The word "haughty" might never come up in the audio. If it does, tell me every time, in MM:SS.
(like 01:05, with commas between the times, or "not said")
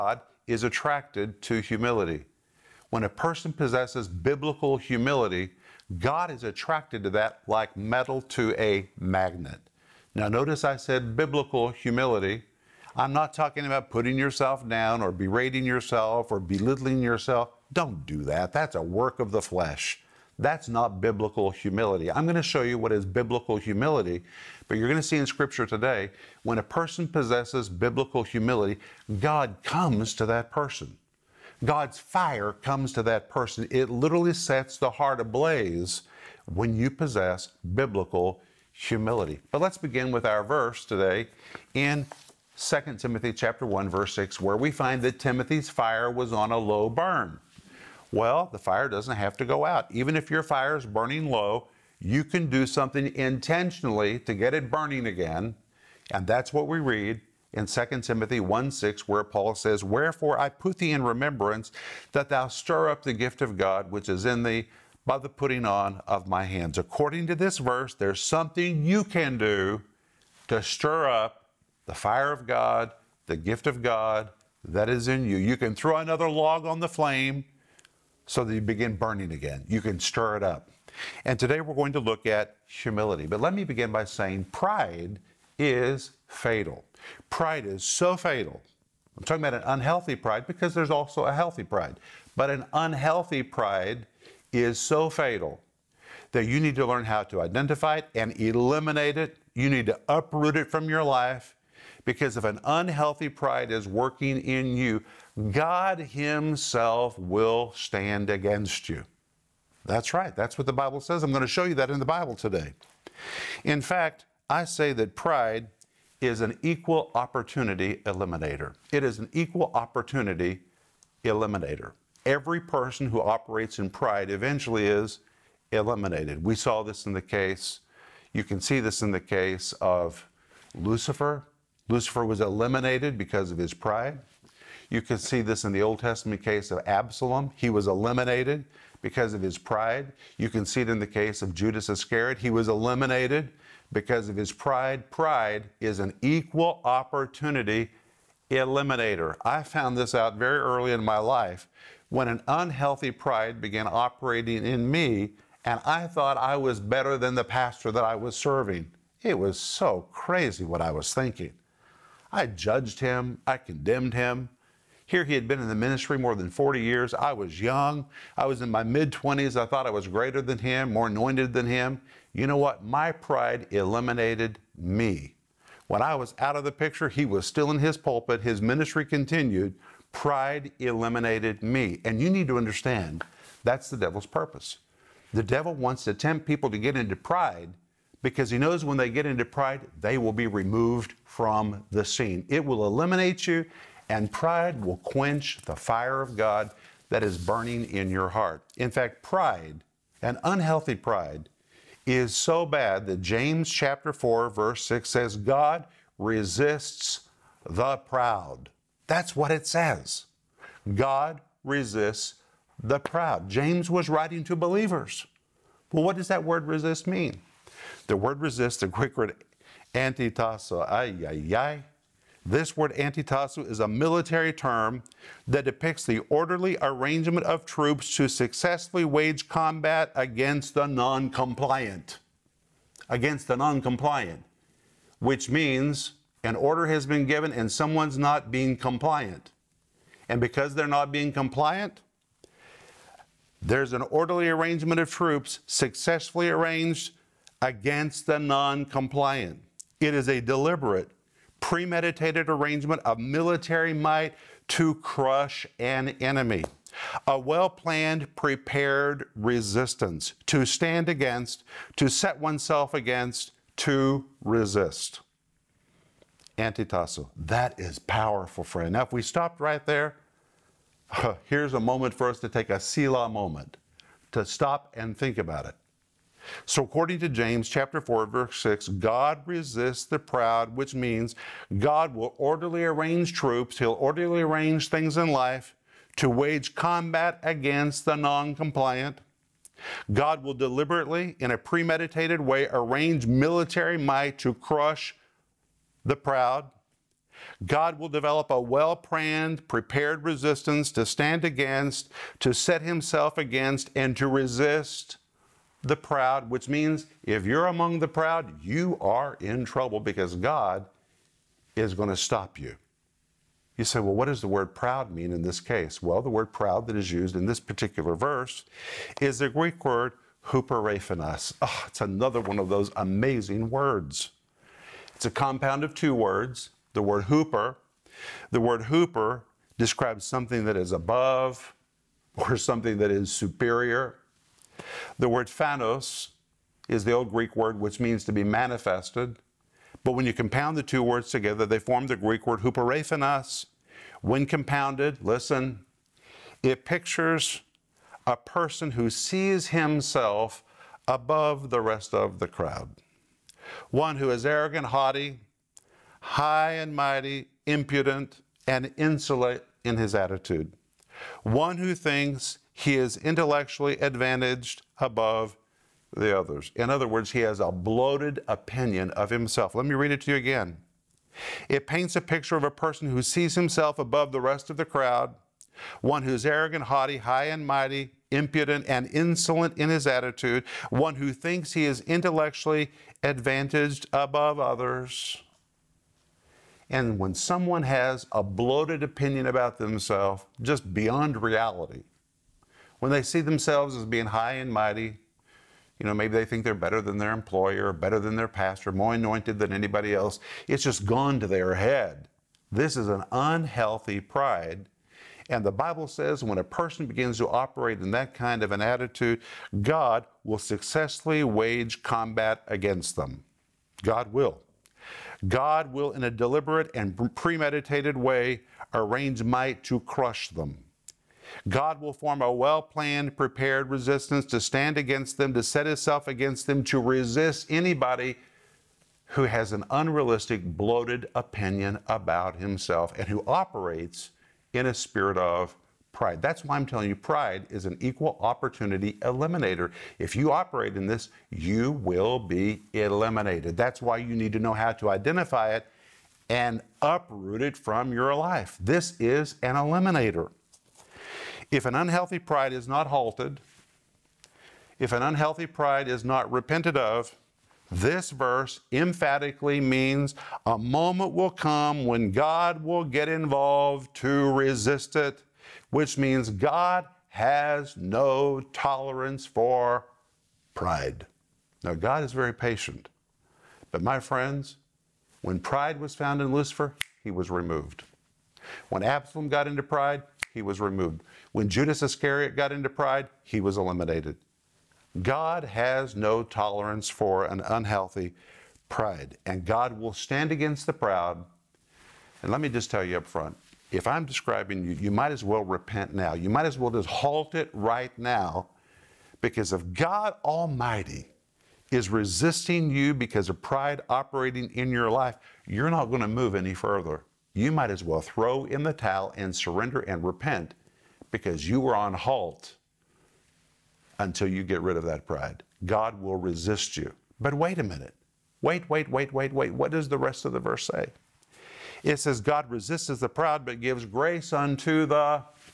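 05:54, 06:16.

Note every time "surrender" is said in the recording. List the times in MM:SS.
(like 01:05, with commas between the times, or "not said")
08:29.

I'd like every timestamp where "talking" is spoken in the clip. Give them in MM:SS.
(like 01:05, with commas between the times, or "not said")
00:13, 01:29.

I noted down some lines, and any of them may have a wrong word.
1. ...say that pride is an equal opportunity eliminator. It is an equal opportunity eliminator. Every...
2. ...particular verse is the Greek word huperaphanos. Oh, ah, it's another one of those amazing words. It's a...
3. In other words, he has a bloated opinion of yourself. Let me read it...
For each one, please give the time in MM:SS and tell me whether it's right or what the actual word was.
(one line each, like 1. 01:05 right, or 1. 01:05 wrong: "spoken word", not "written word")
1. 01:54 right
2. 05:17 right
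3. 06:06 wrong: "himself", not "yourself".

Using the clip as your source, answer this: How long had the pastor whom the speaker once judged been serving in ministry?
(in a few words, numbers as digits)
more than 40 years.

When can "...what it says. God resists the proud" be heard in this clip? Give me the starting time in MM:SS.
03:29.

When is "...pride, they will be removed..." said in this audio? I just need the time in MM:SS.
03:09.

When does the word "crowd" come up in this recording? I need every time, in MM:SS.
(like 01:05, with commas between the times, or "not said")
05:52, 06:14.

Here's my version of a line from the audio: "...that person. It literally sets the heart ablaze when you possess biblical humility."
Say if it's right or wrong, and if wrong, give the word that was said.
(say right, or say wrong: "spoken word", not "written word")
right.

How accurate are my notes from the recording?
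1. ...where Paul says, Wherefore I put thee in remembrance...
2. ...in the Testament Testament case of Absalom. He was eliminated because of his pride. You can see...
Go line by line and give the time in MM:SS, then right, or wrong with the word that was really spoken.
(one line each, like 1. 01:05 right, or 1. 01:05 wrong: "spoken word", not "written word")
1. 00:59 right
2. 02:15 wrong: "Old", not "Testament".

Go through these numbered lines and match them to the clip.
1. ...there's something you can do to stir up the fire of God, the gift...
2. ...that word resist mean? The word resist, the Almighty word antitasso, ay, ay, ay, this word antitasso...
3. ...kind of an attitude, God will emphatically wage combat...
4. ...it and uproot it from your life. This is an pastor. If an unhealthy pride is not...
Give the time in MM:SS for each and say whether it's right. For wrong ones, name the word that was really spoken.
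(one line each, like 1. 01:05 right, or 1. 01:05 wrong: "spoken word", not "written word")
1. 01:07 right
2. 03:36 wrong: "Greek", not "Almighty"
3. 06:48 wrong: "successfully", not "emphatically"
4. 07:25 wrong: "eliminator", not "pastor".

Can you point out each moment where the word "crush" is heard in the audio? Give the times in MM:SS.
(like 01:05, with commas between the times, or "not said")
04:14, 04:54, 07:00.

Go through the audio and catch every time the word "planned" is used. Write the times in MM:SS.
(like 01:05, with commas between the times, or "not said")
04:17, 04:58, 07:02.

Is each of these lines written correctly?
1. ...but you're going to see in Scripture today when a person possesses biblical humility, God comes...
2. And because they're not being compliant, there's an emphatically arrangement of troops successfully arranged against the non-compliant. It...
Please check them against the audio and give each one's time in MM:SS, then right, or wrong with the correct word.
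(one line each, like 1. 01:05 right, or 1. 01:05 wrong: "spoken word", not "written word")
1. 00:24 right
2. 04:00 wrong: "orderly", not "emphatically".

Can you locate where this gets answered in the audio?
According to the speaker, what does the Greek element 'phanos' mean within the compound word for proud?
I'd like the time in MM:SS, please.
05:38.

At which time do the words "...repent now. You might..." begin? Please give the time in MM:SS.
08:15.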